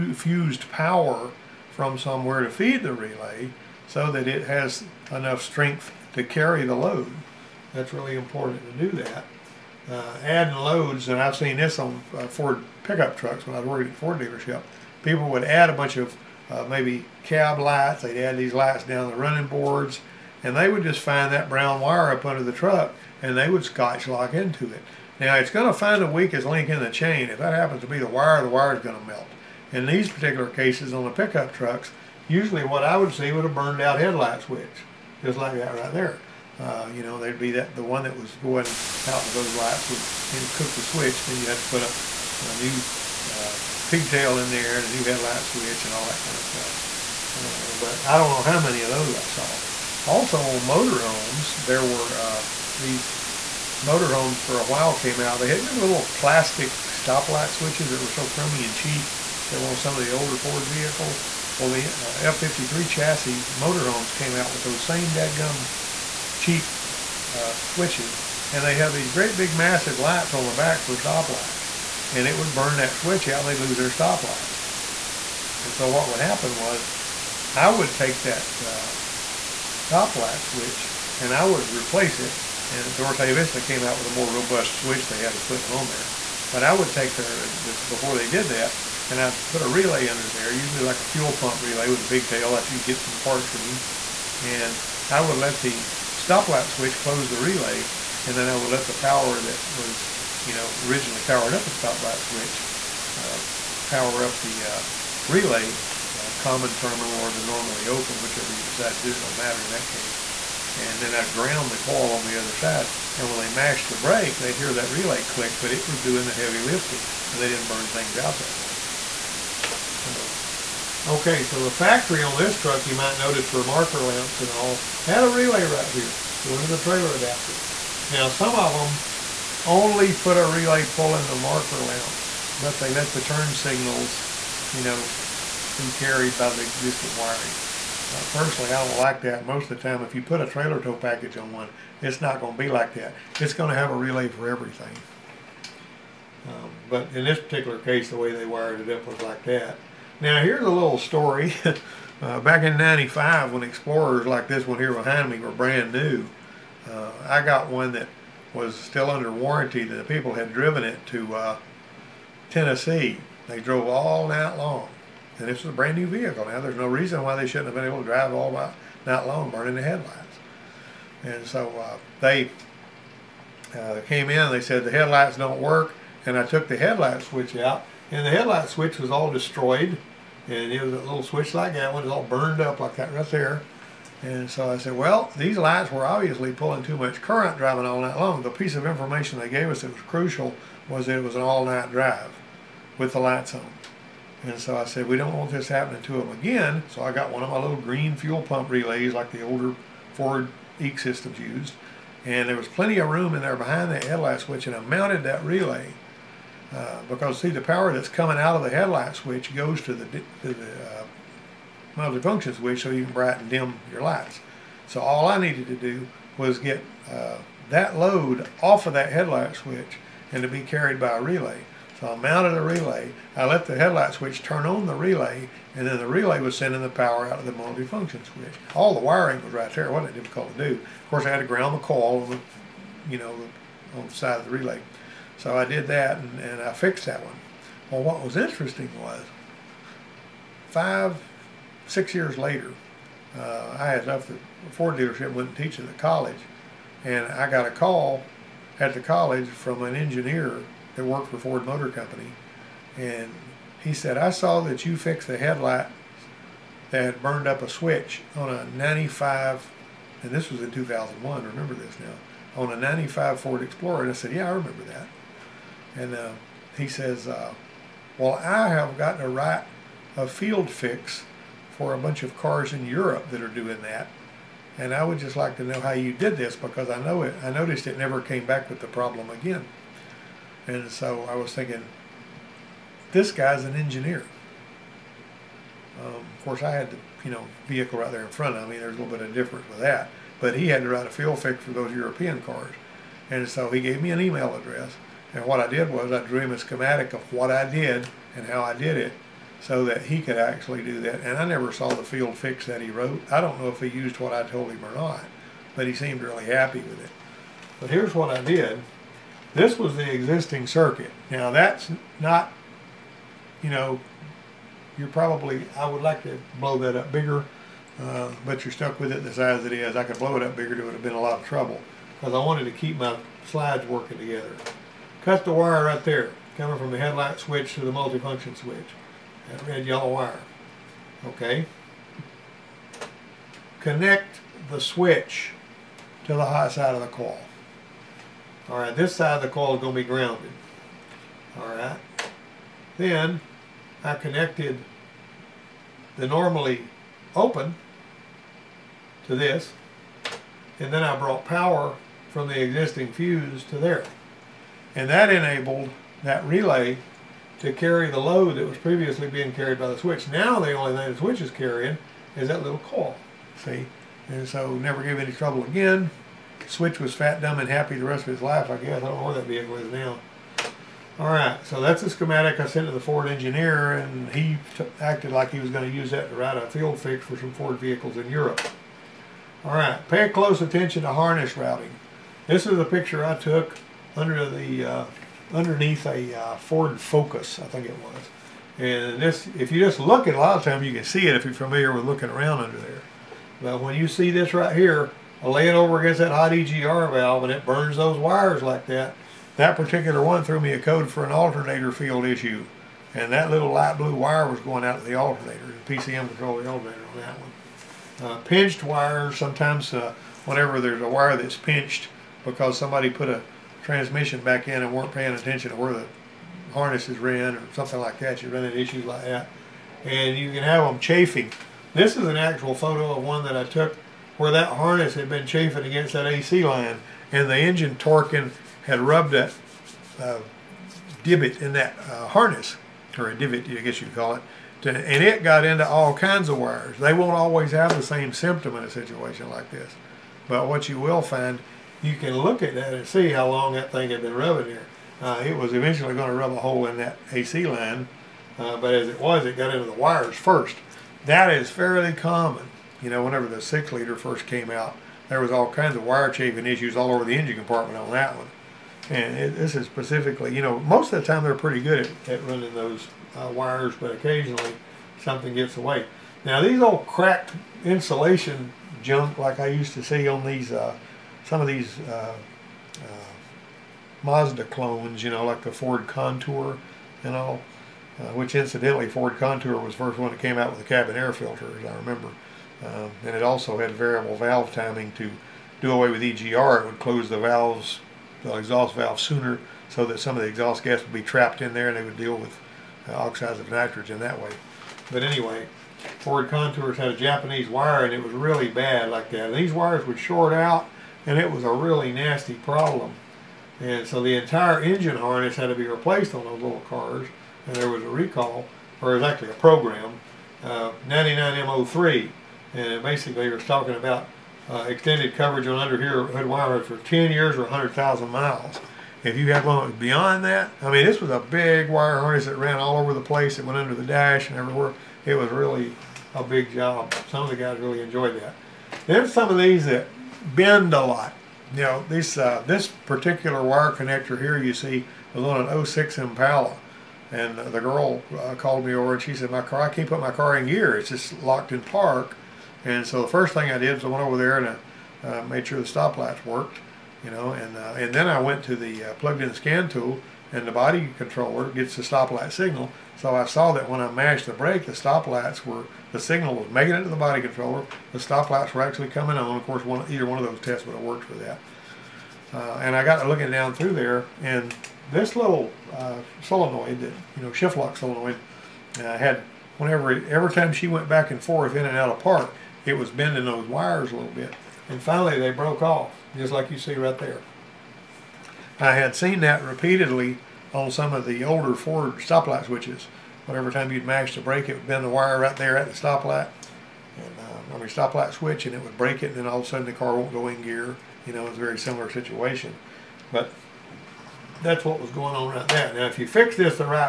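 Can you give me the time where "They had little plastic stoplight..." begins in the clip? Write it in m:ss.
0:55.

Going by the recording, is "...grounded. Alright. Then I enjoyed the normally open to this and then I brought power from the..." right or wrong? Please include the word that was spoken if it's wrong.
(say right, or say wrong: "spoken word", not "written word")
wrong: "connected", not "enjoyed".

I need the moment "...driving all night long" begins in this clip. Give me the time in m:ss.
3:07.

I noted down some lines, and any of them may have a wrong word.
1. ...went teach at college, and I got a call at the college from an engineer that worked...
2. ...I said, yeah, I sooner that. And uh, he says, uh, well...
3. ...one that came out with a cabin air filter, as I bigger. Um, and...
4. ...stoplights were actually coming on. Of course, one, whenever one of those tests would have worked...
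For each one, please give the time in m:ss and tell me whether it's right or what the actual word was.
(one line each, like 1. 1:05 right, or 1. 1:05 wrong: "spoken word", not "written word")
1. 4:05 right
2. 4:24 wrong: "remember", not "sooner"
3. 8:00 wrong: "remember", not "bigger"
4. 9:18 wrong: "either", not "whenever".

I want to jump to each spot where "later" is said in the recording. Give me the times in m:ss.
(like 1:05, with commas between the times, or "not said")
4:02.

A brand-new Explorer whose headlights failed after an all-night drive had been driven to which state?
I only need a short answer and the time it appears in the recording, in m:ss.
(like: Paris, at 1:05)
Tennessee, at 2:42.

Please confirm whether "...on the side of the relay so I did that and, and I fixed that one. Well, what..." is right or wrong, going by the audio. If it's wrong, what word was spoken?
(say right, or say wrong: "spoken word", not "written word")
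right.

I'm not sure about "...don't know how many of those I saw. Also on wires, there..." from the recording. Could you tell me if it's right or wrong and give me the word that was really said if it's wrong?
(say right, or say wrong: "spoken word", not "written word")
wrong: "motorhomes", not "wires".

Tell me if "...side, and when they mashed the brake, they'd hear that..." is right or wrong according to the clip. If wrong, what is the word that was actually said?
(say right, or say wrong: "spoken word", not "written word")
right.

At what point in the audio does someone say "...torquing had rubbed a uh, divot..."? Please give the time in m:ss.
7:07.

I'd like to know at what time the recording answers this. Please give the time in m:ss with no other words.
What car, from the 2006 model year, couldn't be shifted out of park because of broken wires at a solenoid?
8:56.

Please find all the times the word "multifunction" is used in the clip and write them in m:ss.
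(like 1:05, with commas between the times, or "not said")
3:31, 5:27.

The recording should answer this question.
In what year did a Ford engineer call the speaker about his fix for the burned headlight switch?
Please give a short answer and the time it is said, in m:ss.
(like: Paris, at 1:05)
2001, at 4:20.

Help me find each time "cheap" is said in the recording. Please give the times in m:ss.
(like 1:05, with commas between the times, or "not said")
0:58, 1:06.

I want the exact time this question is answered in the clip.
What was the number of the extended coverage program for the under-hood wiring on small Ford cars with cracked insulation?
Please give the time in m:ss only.
8:31.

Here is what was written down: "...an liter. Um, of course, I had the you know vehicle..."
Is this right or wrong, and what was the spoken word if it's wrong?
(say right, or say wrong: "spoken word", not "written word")
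wrong: "engineer", not "liter".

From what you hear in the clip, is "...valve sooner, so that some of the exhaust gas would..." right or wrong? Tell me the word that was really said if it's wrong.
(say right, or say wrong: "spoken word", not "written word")
right.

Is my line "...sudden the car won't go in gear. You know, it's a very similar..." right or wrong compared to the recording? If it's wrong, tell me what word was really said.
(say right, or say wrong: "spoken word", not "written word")
right.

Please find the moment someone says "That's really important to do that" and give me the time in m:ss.
0:07.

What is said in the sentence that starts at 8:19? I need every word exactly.
These wires would short out and it was a really nasty problem.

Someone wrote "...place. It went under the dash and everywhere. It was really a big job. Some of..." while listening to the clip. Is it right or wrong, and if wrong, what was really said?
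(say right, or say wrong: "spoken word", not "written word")
right.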